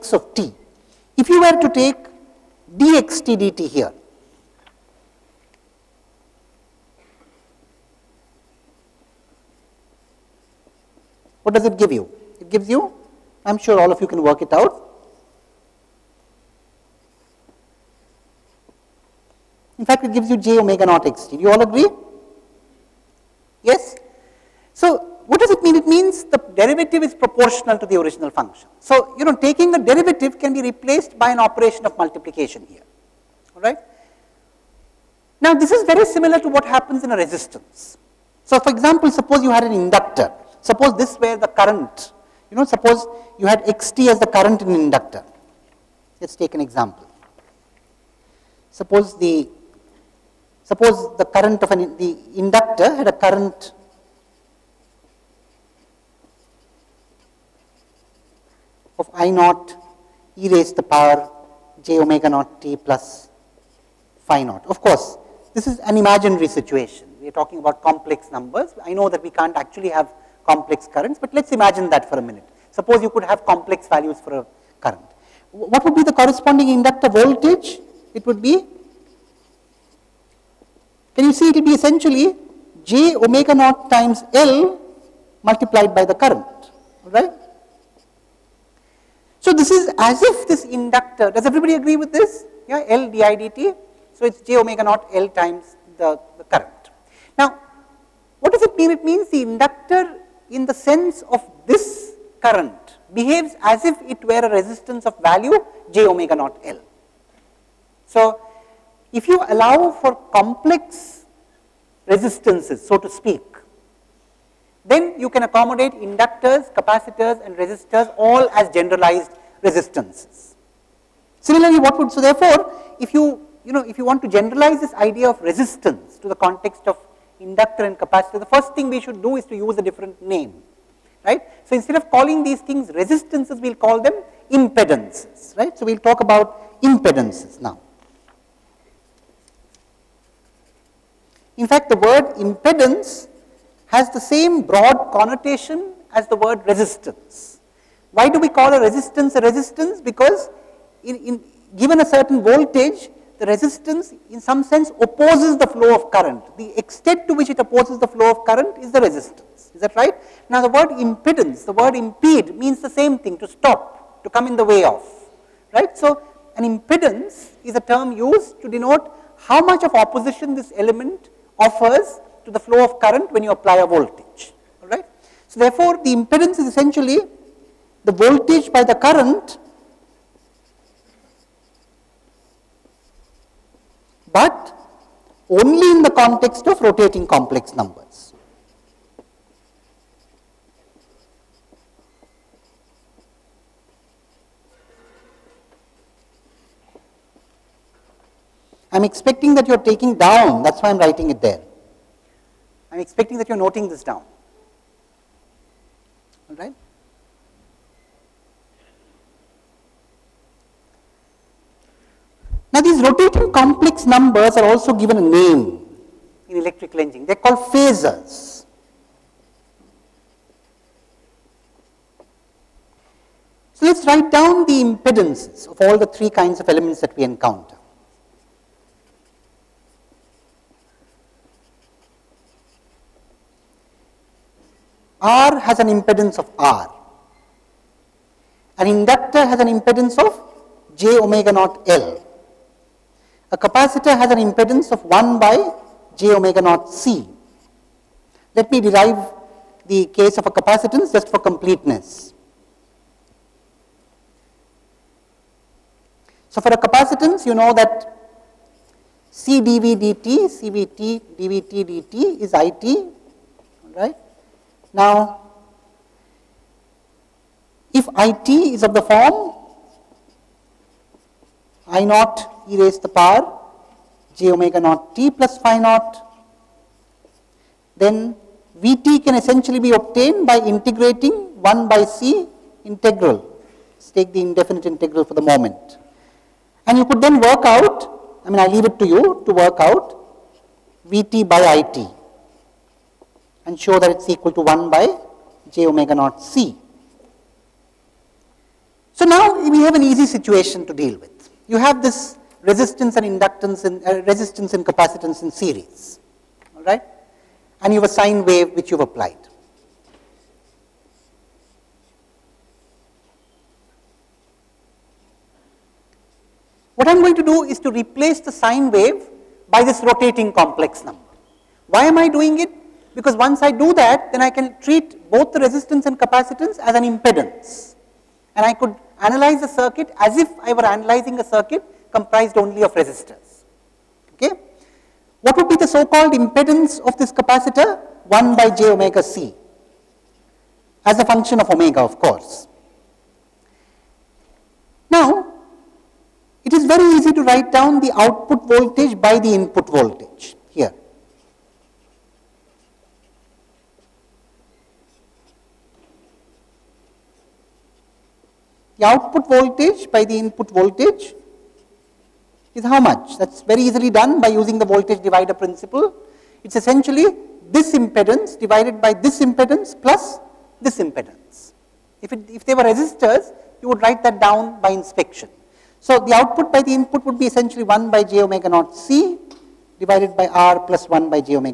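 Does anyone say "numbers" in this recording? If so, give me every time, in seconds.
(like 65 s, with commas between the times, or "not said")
68 s, 187 s, 214 s, 321 s.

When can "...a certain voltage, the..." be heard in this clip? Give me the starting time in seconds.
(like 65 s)
152 s.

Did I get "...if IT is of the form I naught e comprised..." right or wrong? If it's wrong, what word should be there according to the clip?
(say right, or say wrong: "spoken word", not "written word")
wrong: "raised", not "comprised".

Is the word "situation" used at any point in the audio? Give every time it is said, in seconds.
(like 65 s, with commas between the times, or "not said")
66 s, 300 s.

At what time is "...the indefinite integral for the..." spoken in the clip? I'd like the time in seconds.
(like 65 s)
284 s.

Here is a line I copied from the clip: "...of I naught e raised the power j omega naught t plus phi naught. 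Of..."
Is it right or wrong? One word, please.
right.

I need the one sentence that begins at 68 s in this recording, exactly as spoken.
I know that we can't actually have complex currents, but let's imagine that for a minute.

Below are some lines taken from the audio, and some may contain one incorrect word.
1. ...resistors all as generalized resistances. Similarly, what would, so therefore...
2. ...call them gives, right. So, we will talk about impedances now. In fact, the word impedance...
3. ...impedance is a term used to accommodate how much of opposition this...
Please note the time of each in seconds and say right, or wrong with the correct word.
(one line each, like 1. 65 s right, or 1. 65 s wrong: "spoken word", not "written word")
1. 117 s right
2. 133 s wrong: "impedances", not "gives"
3. 166 s wrong: "denote", not "accommodate".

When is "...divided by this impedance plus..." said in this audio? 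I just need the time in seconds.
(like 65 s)
368 s.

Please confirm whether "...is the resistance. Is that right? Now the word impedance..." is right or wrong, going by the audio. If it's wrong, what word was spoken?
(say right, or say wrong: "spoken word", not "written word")
right.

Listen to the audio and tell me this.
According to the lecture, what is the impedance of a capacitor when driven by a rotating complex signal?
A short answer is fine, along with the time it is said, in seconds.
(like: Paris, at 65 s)
1 by j omega naught C, at 244 s.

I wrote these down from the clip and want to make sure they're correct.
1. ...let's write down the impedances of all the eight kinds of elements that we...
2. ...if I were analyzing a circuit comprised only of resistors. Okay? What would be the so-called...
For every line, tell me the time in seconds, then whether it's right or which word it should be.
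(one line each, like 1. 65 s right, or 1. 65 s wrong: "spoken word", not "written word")
1. 223 s wrong: "three", not "eight"
2. 330 s right.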